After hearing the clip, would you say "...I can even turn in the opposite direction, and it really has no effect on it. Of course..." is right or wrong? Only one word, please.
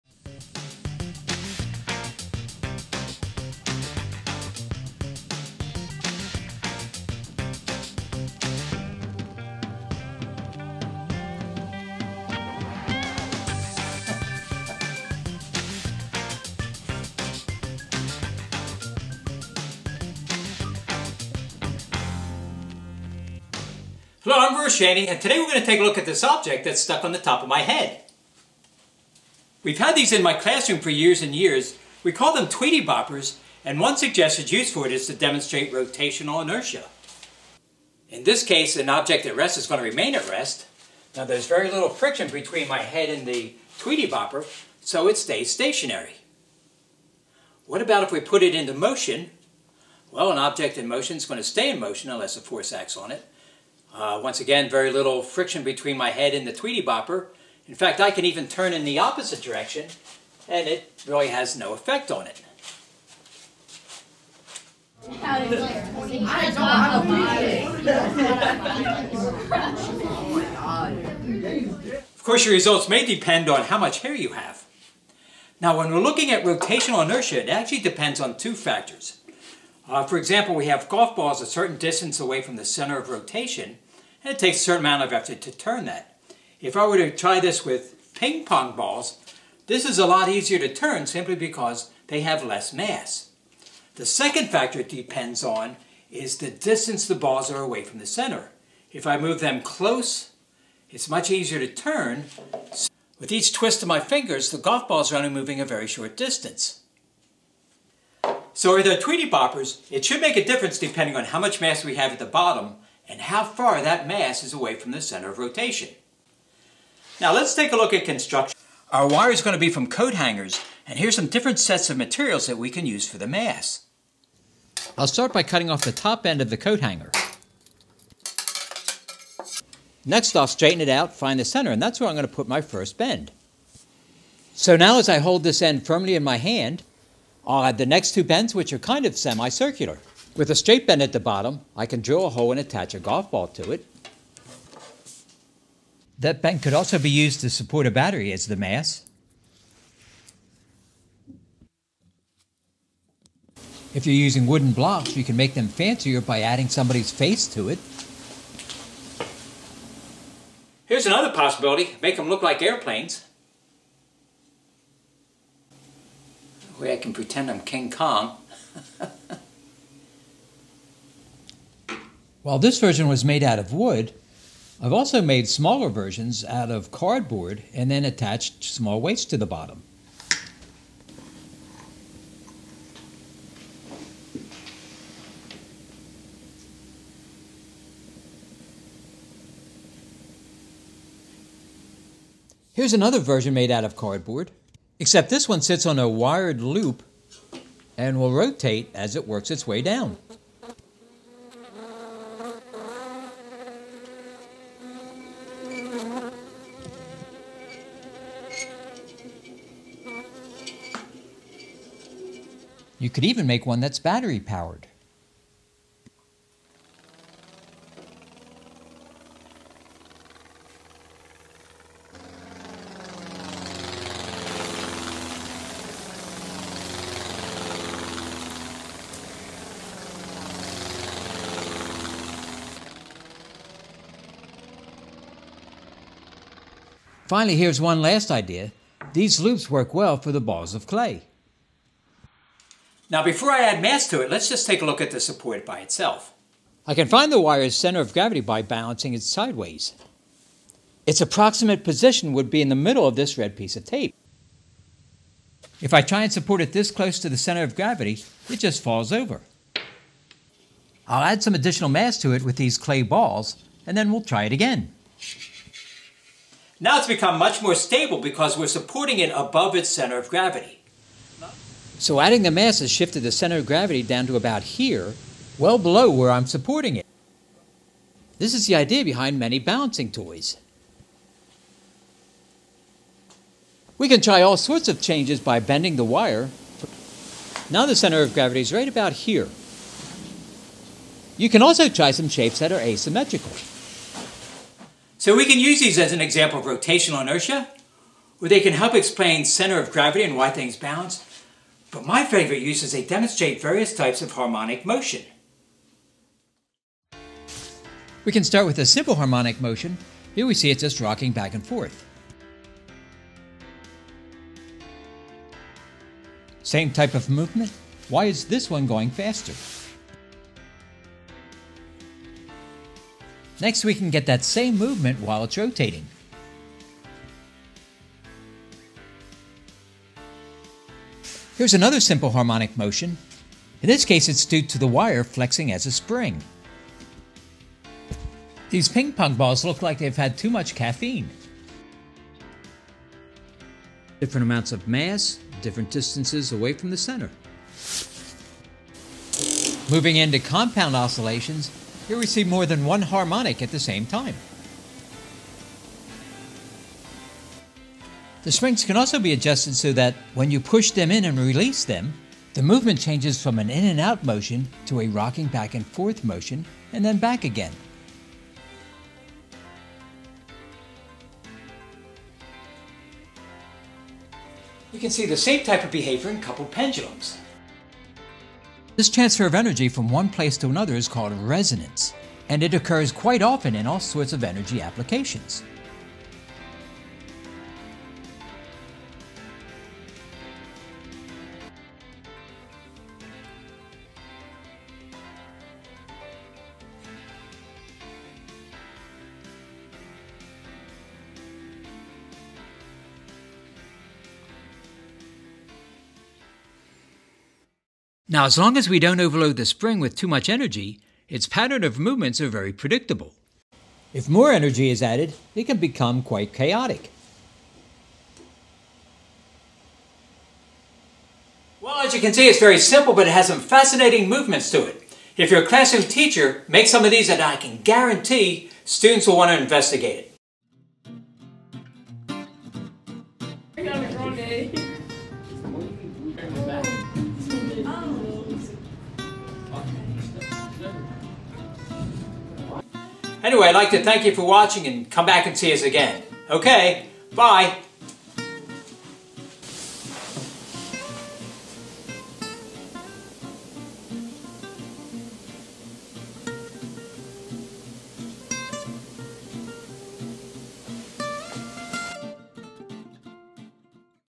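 right.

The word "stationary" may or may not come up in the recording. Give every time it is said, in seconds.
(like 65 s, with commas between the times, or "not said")
45 s.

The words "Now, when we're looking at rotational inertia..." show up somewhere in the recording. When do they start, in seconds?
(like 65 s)
75 s.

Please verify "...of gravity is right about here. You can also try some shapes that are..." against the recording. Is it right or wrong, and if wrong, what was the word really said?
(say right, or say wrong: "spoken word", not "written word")
right.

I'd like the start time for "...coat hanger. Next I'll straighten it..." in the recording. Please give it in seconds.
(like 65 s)
126 s.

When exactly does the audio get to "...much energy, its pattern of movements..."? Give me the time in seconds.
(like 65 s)
410 s.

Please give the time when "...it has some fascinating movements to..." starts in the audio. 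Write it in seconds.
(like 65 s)
423 s.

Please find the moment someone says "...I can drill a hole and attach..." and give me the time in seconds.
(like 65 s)
141 s.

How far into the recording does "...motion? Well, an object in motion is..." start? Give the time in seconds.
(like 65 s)
48 s.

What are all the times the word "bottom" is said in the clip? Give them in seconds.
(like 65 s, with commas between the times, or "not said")
112 s, 141 s, 179 s.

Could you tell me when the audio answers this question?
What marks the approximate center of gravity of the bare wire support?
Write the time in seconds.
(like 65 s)
253 s.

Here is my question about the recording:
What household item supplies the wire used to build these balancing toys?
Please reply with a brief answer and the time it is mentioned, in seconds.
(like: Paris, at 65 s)
coat hangers, at 119 s.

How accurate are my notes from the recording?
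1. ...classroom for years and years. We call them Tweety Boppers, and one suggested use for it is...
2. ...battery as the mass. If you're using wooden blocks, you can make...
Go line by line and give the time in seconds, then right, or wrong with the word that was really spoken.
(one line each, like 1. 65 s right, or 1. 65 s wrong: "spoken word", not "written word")
1. 30 s right
2. 147 s right.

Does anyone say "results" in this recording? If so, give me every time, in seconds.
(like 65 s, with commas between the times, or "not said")
72 s.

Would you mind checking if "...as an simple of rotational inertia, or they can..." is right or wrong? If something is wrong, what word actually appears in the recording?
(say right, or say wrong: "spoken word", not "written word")
wrong: "example", not "simple".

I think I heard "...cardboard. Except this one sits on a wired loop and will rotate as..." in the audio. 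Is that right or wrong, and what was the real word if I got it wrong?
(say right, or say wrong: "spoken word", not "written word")
right.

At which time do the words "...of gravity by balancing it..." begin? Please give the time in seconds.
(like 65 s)
248 s.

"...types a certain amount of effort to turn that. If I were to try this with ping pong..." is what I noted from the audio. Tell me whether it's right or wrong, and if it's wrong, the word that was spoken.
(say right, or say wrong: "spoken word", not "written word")
wrong: "takes", not "types".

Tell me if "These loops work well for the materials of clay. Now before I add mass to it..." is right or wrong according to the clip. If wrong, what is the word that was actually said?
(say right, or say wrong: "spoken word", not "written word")
wrong: "balls", not "materials".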